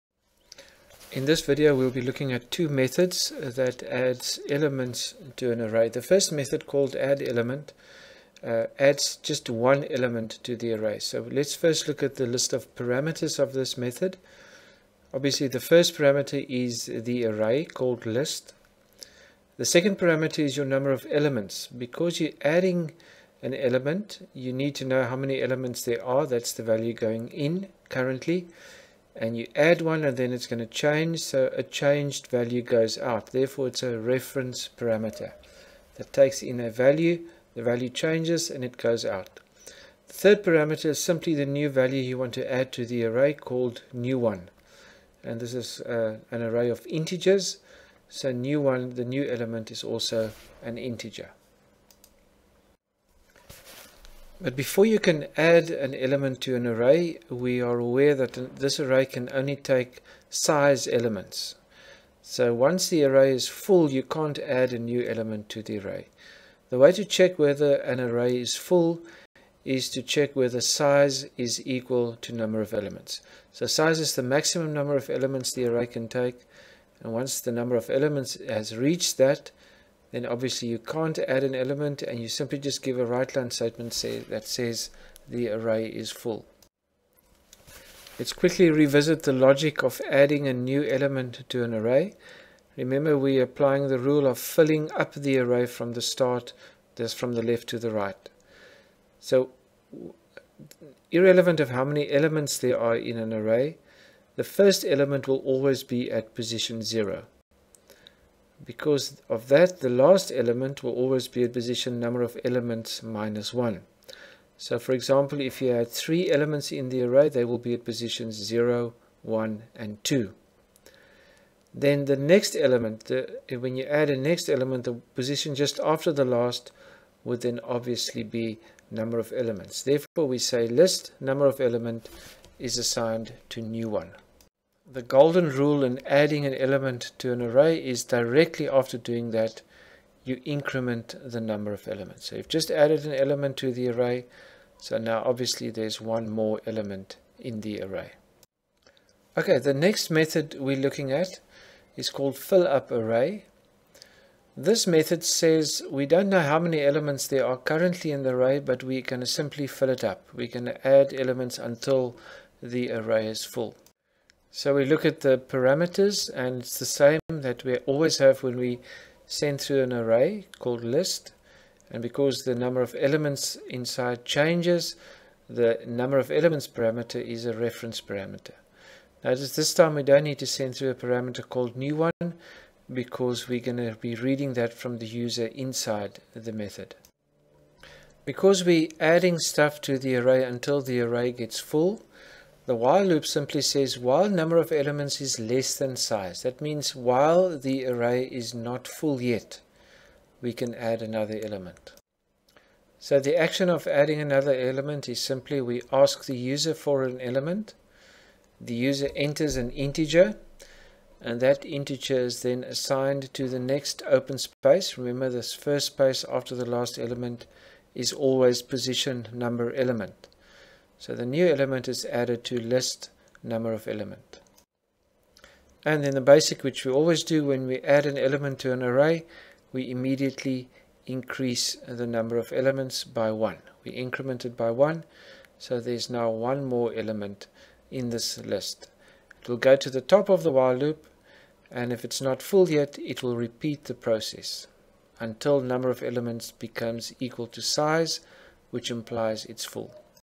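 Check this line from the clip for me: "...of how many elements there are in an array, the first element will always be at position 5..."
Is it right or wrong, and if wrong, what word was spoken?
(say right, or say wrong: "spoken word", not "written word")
wrong: "0", not "5".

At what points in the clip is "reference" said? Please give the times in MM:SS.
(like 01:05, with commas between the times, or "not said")
00:33, 02:57.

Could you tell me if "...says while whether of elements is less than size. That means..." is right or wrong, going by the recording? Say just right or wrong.
wrong.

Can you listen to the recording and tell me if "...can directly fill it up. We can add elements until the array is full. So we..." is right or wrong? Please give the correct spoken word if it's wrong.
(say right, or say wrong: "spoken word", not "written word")
wrong: "simply", not "directly".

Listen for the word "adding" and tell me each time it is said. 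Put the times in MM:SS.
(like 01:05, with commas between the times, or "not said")
00:22, 01:30, 02:16, 03:08, 03:23.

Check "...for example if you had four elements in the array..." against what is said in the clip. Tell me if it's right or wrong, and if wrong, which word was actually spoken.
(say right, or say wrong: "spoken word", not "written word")
wrong: "three", not "four".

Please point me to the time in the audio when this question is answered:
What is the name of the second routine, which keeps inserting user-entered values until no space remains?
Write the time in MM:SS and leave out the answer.
02:32.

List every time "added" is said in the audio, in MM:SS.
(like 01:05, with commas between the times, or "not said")
02:22, 03:42.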